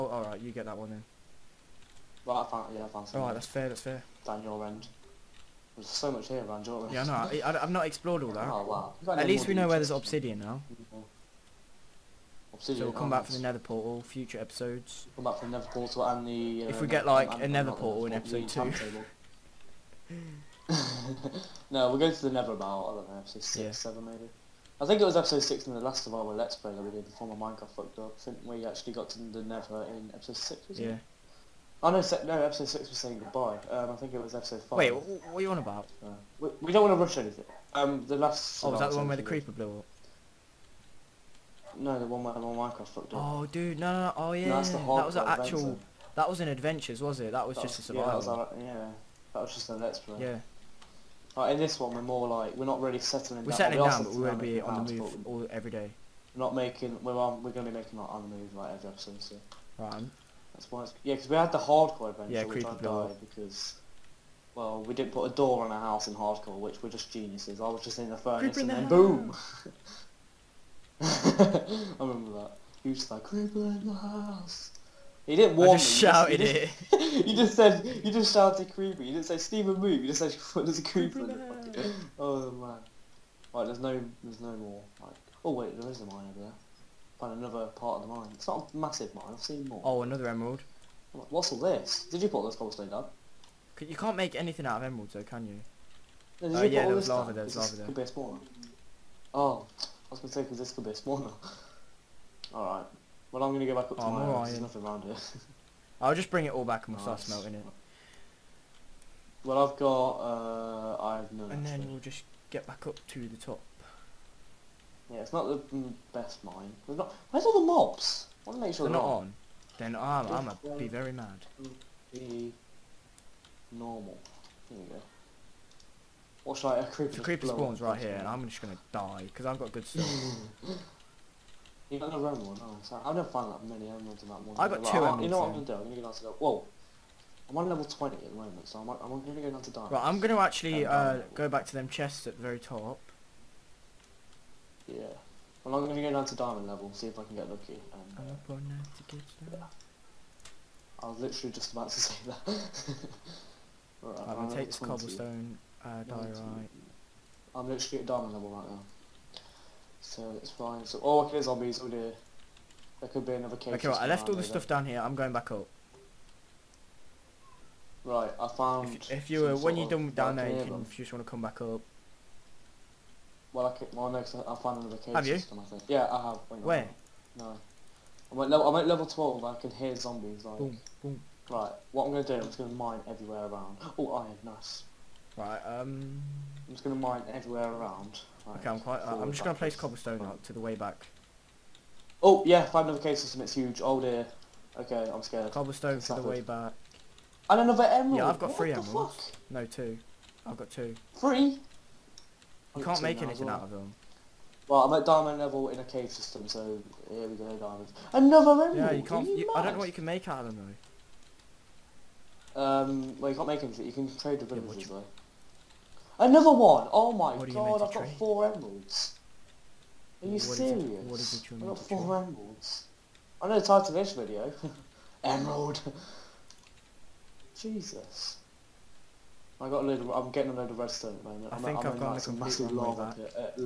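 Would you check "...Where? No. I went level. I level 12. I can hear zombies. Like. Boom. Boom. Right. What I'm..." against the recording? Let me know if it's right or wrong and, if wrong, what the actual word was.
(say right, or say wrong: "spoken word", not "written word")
right.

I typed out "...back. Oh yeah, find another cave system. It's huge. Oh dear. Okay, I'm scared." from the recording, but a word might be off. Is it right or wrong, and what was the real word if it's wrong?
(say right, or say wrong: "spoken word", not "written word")
right.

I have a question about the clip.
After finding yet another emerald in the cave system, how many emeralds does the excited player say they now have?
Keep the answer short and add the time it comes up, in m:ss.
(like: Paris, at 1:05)
4, at 3:38.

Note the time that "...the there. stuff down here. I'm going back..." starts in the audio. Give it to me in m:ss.
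2:44.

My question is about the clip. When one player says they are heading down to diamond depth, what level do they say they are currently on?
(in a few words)
20.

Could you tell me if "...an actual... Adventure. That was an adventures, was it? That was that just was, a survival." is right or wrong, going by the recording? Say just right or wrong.
right.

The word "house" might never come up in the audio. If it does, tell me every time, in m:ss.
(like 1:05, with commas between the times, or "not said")
1:05, 1:13, 1:44.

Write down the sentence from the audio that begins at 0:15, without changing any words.
Come back for the nether portal and the...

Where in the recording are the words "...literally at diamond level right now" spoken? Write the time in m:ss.
2:37.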